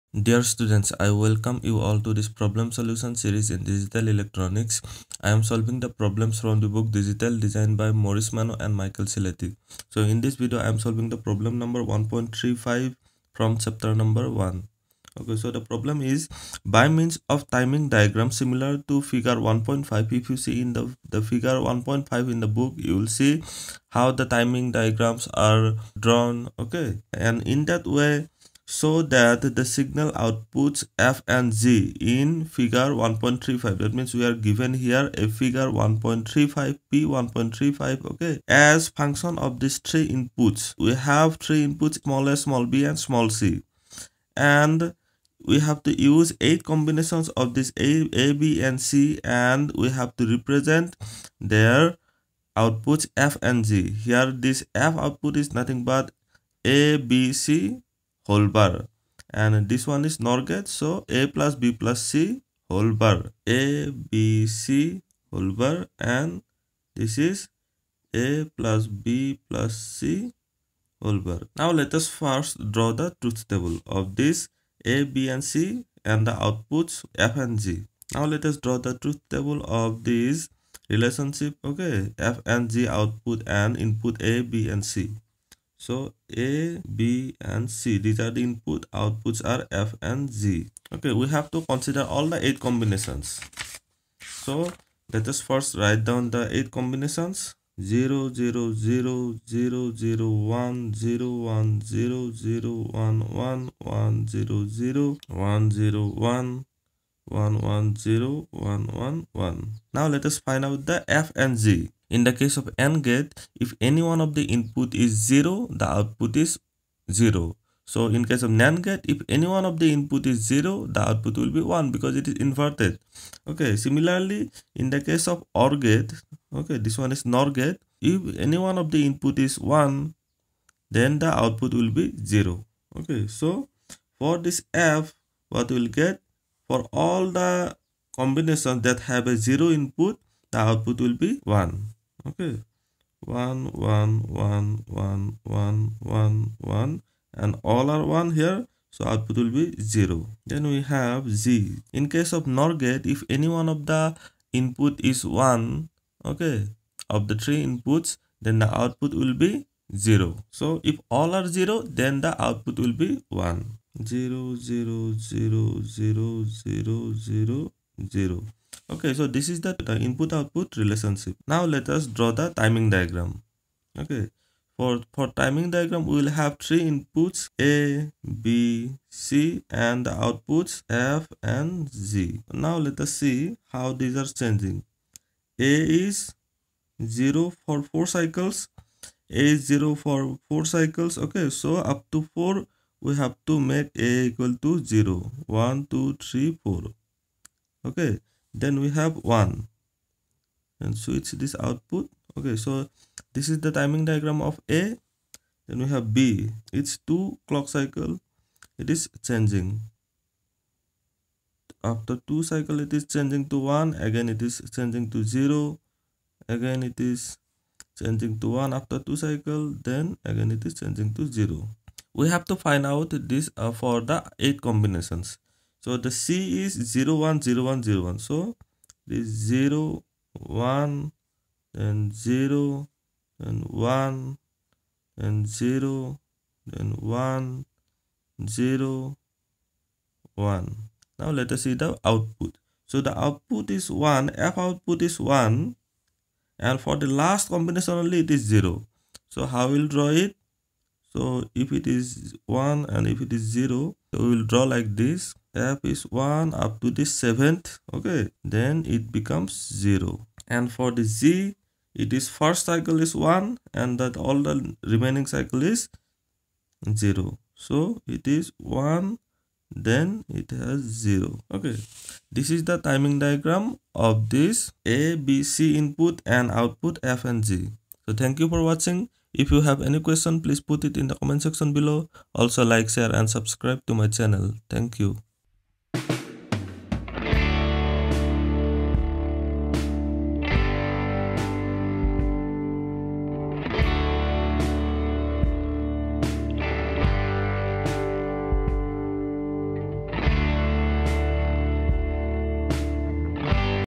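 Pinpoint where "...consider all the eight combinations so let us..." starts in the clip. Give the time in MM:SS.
01:31.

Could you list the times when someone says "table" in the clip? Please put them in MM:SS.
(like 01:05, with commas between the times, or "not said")
01:13, 01:19.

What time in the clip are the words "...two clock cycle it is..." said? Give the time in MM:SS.
03:27.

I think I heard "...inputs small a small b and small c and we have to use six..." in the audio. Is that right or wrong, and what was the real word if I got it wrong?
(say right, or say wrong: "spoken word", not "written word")
wrong: "eight", not "six".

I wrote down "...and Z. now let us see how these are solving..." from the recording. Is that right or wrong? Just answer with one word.
wrong.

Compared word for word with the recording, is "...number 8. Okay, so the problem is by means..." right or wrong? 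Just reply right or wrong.
wrong.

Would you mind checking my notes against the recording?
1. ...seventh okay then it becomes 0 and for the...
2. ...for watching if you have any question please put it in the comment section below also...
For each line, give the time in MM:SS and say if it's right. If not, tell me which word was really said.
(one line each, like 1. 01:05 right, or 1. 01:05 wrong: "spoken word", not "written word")
1. 04:17 right
2. 04:38 right.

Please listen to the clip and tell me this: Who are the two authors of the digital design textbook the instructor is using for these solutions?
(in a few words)
Morris Mano and Michael Ciletti.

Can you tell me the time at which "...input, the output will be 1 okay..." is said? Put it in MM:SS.
02:19.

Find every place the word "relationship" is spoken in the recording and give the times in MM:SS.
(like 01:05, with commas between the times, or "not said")
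01:20, 02:50.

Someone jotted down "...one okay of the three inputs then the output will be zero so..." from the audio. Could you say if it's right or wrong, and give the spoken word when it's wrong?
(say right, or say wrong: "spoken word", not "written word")
right.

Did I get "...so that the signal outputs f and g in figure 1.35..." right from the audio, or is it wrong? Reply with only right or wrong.
right.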